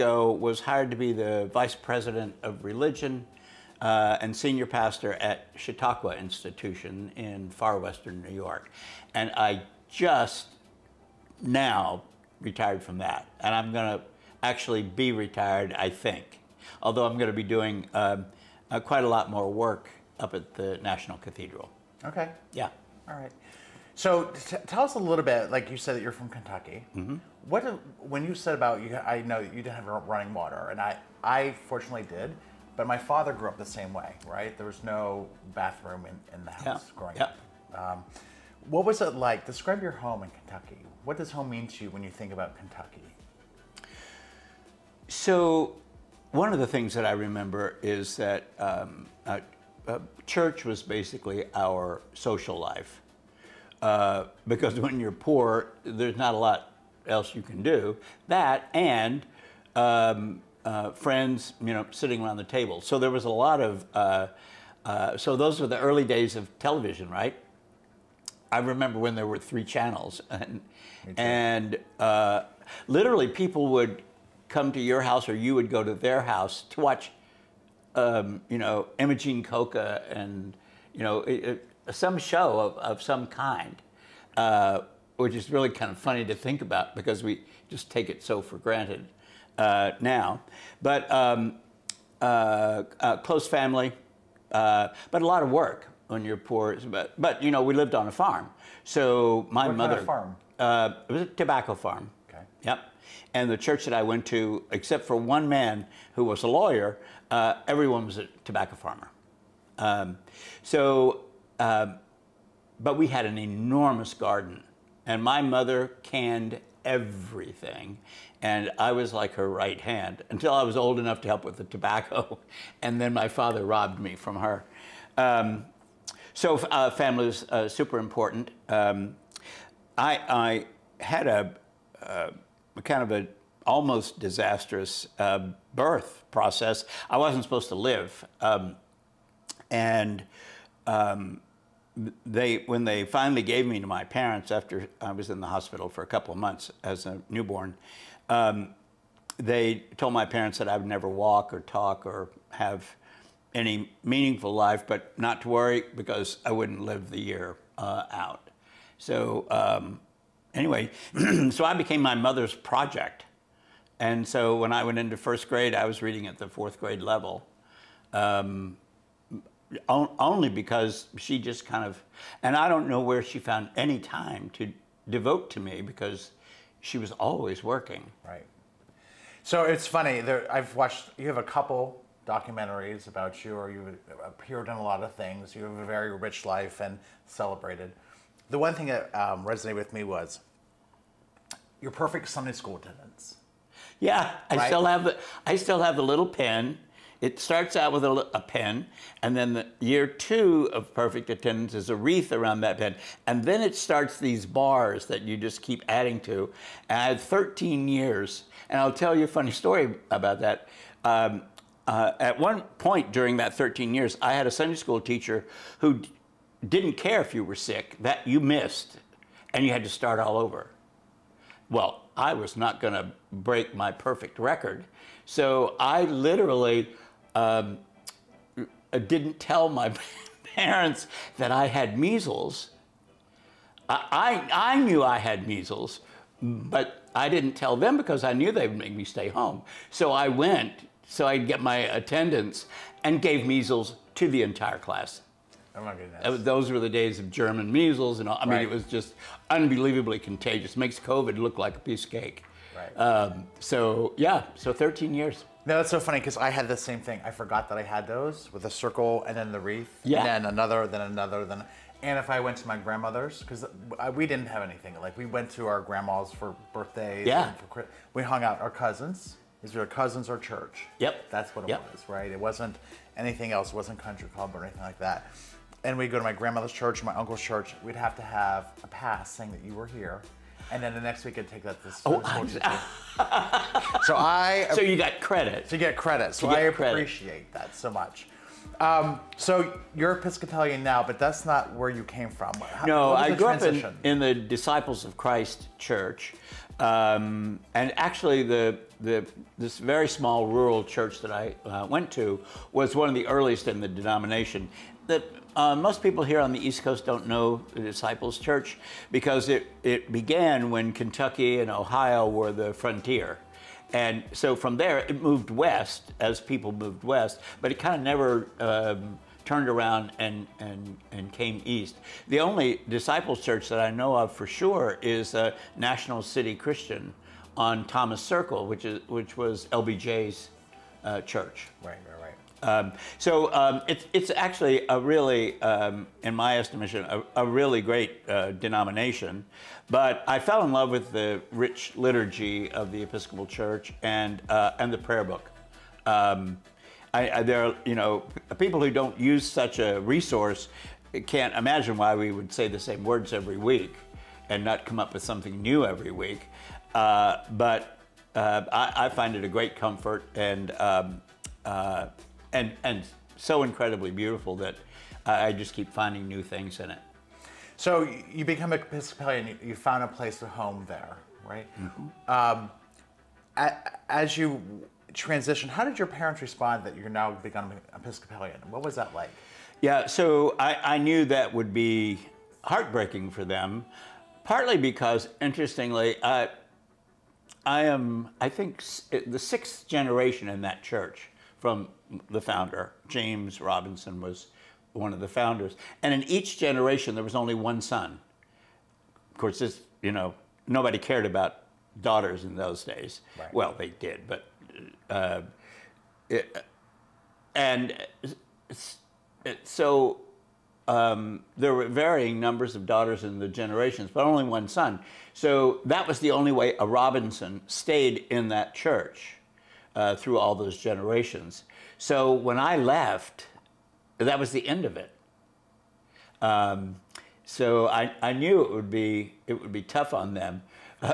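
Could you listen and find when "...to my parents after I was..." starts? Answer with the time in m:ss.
2:23.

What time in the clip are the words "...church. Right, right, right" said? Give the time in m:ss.
5:31.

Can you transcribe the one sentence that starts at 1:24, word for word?
Uh, which is really kind of funny to think about because we just take it so for granted uh, now.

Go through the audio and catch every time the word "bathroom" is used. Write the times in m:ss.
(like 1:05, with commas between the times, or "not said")
0:35.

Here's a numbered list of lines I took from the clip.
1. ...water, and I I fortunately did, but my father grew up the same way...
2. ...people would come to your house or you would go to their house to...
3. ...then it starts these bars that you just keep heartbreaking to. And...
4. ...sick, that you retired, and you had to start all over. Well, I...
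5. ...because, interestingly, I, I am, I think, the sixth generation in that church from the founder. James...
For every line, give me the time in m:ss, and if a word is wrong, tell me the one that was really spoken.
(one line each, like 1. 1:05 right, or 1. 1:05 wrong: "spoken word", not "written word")
1. 0:30 right
2. 1:13 right
3. 3:23 wrong: "adding", not "heartbreaking"
4. 3:37 wrong: "missed", not "retired"
5. 6:24 right.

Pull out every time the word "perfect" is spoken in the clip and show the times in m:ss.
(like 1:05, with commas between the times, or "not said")
3:11, 3:20, 3:43.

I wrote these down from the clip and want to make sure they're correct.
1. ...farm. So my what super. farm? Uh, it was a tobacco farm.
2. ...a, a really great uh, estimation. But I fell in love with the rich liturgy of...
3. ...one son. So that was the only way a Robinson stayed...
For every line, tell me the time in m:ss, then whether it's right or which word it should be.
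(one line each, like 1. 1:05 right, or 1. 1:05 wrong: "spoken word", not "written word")
1. 1:38 wrong: "mother", not "super"
2. 5:37 wrong: "denomination", not "estimation"
3. 6:54 right.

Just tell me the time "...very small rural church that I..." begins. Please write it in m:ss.
4:59.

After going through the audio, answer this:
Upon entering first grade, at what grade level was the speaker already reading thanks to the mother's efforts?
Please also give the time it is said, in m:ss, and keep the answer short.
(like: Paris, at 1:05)
Fourth grade, at 2:46.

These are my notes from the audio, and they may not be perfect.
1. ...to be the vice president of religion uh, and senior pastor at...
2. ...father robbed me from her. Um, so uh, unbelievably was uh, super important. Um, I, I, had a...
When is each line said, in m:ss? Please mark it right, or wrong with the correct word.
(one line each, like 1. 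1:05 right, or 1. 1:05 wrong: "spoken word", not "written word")
1. 0:00 right
2. 2:03 wrong: "family", not "unbelievably".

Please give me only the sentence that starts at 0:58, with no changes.
That and um, uh, friends, you know, sitting around the table.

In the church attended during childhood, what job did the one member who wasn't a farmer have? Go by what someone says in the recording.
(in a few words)
Lawyer.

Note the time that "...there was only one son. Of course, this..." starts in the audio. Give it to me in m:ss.
6:37.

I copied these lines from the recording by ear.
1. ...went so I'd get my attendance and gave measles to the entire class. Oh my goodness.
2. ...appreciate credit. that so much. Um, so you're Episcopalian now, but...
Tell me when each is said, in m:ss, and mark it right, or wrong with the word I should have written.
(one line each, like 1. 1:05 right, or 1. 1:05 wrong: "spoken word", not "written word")
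1. 4:00 right
2. 4:46 right.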